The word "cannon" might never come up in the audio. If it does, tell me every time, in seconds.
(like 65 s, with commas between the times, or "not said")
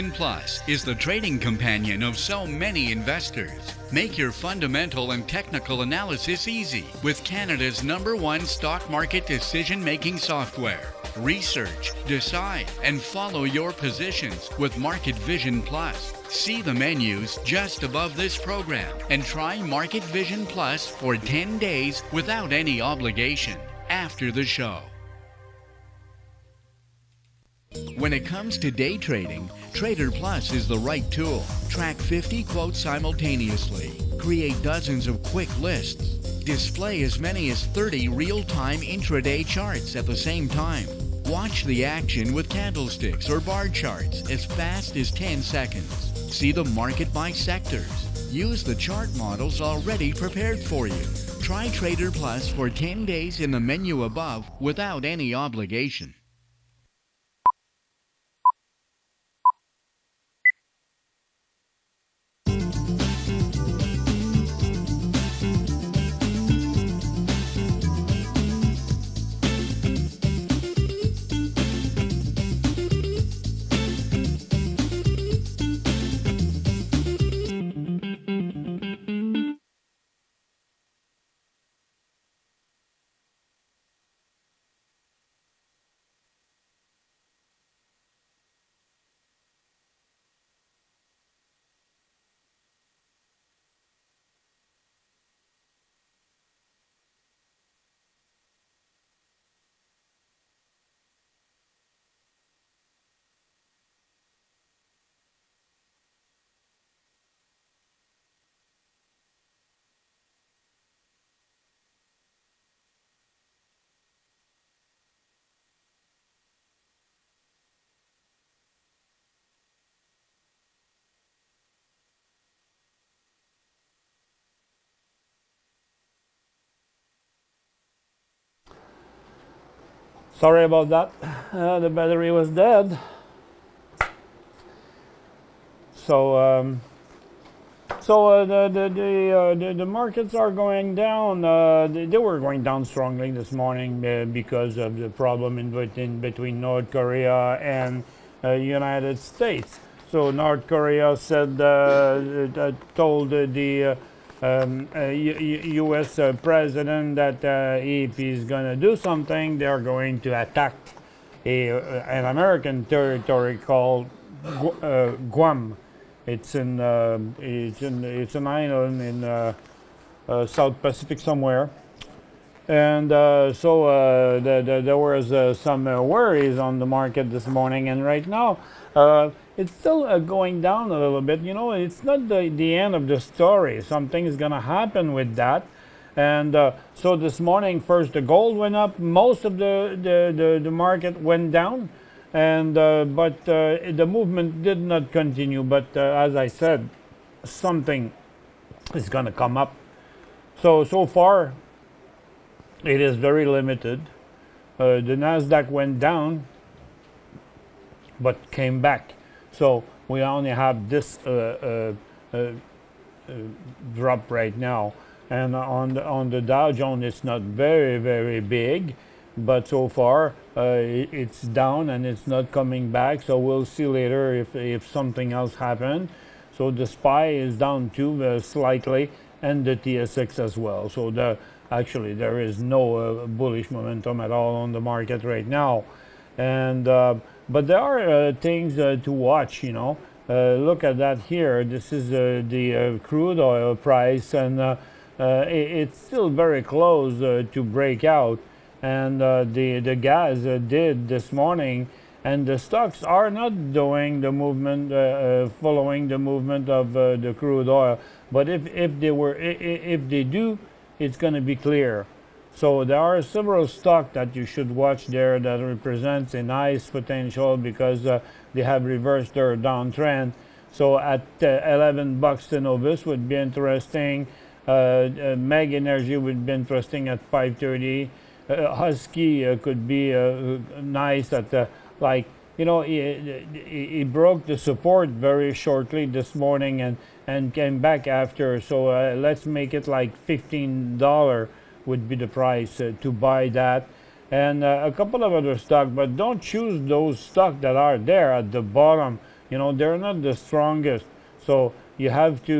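not said.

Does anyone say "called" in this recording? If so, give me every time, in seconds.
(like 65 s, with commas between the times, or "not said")
163 s.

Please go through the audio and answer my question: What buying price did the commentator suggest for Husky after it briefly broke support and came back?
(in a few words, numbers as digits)
$15.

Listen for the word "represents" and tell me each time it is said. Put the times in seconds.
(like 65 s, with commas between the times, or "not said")
265 s.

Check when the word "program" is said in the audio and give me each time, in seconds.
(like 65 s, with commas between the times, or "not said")
18 s.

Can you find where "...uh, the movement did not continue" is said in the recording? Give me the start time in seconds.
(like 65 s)
193 s.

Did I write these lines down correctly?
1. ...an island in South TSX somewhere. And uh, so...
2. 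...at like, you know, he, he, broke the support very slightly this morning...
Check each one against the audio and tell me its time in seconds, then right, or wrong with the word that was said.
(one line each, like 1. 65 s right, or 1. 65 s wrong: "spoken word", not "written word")
1. 168 s wrong: "Pacific", not "TSX"
2. 281 s wrong: "shortly", not "slightly".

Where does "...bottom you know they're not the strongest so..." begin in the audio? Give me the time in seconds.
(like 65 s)
298 s.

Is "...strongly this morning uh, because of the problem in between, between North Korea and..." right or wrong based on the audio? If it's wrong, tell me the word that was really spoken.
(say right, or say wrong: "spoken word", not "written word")
right.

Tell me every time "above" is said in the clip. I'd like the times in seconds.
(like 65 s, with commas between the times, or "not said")
17 s, 54 s.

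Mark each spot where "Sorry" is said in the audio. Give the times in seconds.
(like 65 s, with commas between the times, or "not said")
130 s.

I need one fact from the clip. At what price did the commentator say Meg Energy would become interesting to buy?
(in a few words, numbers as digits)
5.30.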